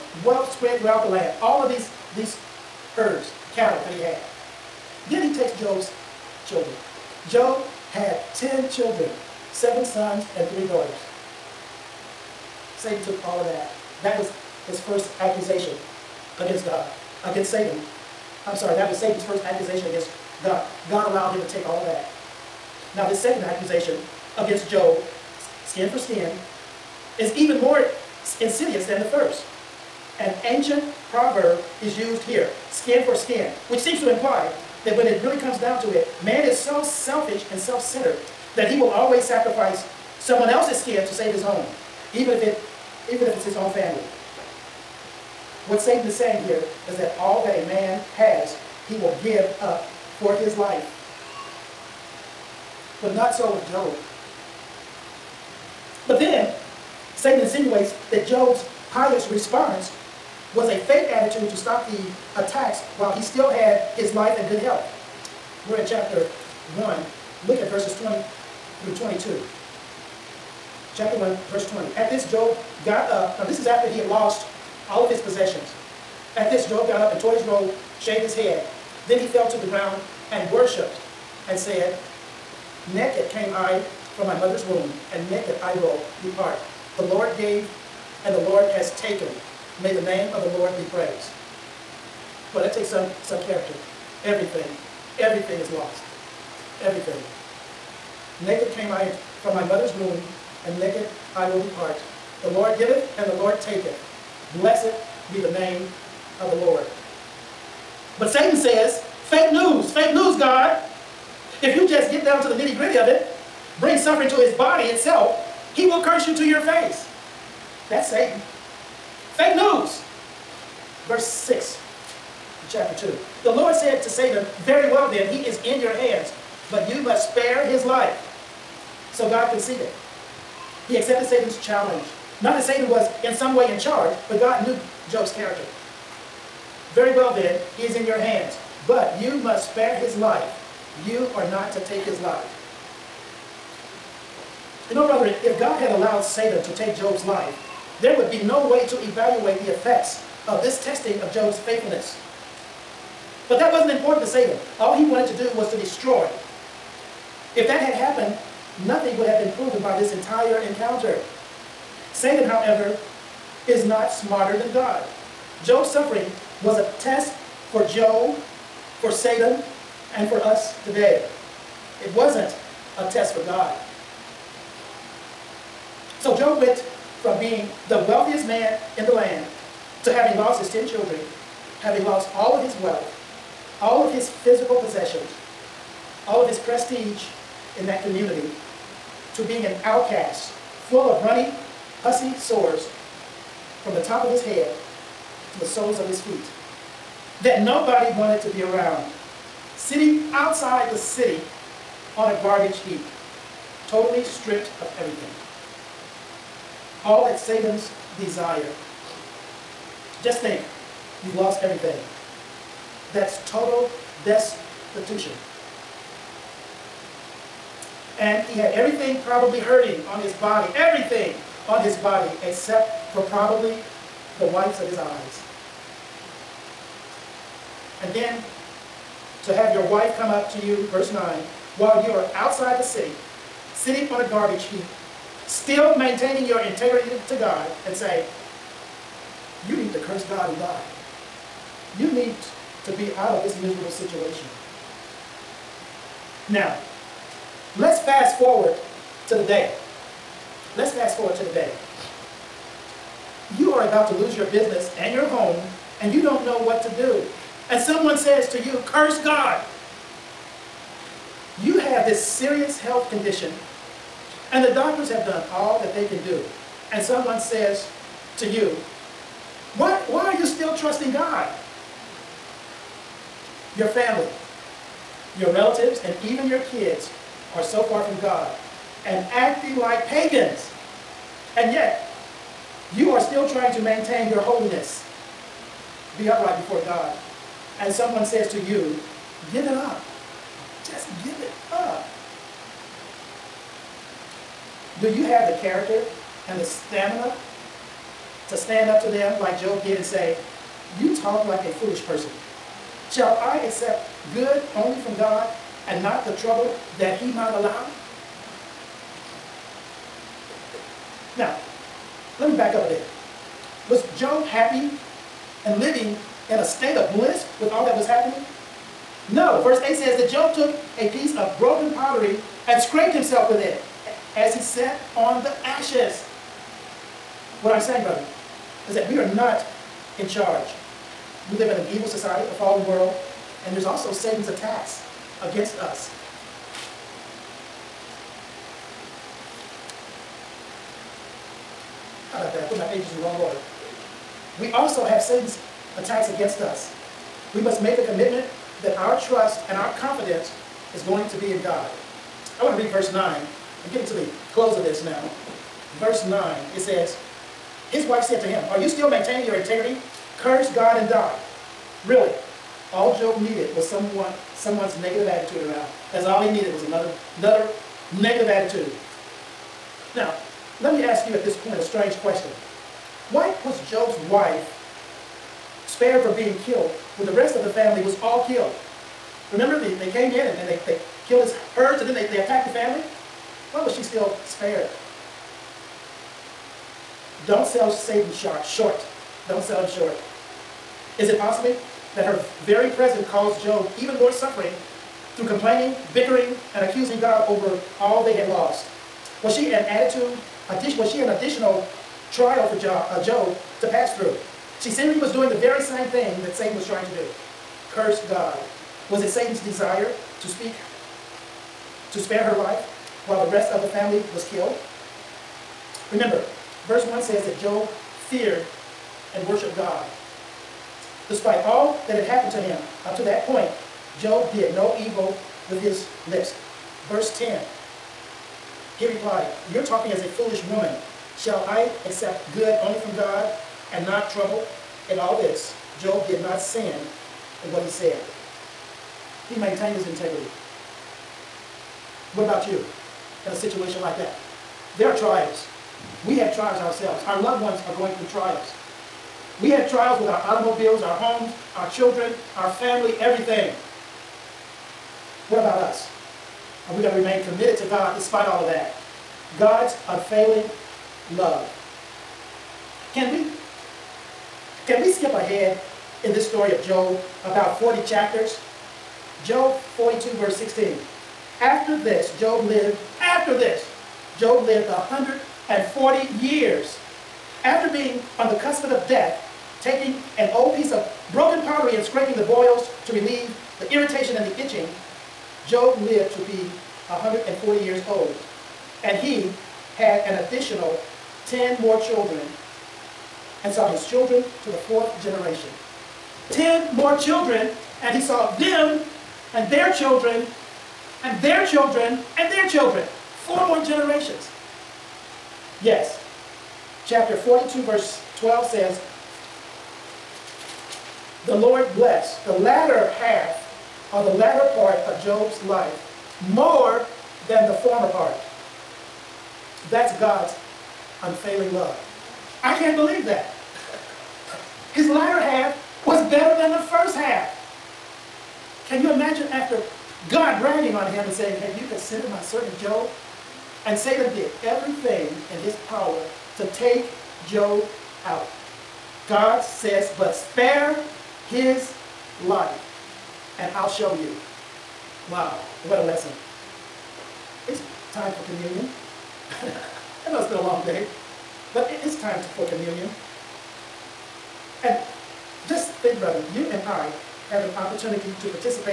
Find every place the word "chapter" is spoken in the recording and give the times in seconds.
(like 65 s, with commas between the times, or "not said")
65 s, 70 s, 122 s, 468 s, 507 s.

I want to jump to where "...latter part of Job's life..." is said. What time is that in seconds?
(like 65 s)
514 s.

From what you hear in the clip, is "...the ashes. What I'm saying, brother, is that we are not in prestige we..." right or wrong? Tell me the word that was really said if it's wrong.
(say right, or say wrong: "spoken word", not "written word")
wrong: "charge", not "prestige".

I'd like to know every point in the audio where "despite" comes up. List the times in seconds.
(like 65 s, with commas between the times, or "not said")
421 s, 458 s.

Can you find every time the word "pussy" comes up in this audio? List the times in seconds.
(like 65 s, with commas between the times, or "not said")
192 s.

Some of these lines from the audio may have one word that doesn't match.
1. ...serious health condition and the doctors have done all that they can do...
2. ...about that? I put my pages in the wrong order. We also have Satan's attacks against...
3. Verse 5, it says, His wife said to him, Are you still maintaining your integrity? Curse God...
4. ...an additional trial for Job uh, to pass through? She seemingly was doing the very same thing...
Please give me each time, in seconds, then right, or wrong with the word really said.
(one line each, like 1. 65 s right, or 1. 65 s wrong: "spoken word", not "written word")
1. 262 s right
2. 342 s right
3. 355 s wrong: "9", not "5"
4. 401 s right.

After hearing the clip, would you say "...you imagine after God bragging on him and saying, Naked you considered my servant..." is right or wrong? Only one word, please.
wrong.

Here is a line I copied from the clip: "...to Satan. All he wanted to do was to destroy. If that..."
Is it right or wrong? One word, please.
right.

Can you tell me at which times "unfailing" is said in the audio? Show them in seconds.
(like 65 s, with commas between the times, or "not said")
460 s, 521 s.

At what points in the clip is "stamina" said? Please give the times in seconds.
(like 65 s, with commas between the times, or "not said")
296 s.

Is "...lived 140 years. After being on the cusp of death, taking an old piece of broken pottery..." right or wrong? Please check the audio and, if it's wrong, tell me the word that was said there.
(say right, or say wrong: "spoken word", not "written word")
right.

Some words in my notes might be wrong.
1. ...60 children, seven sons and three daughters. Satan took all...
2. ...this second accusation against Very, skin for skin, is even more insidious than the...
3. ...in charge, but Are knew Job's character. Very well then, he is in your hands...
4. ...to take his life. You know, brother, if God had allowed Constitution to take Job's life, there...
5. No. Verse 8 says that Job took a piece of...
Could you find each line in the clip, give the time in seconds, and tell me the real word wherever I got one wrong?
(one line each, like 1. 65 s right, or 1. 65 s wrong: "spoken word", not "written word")
1. 8 s wrong: "10", not "60"
2. 23 s wrong: "Job", not "Very"
3. 133 s wrong: "God", not "Are"
4. 141 s wrong: "Satan", not "Constitution"
5. 319 s right.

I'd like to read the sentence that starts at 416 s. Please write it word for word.
Remember, verse 1 says that Job fear, and worship God.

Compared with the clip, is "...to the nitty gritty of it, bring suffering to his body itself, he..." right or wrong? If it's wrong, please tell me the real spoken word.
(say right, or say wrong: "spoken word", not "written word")
right.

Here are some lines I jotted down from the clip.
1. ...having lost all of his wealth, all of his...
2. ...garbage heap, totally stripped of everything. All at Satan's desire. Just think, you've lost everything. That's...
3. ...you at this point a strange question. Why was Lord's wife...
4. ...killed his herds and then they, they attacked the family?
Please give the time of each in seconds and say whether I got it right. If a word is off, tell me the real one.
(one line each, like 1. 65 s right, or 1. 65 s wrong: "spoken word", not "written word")
1. 181 s right
2. 202 s right
3. 371 s wrong: "Job", not "Lord"
4. 381 s right.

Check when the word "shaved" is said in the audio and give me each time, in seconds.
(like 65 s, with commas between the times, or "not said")
77 s.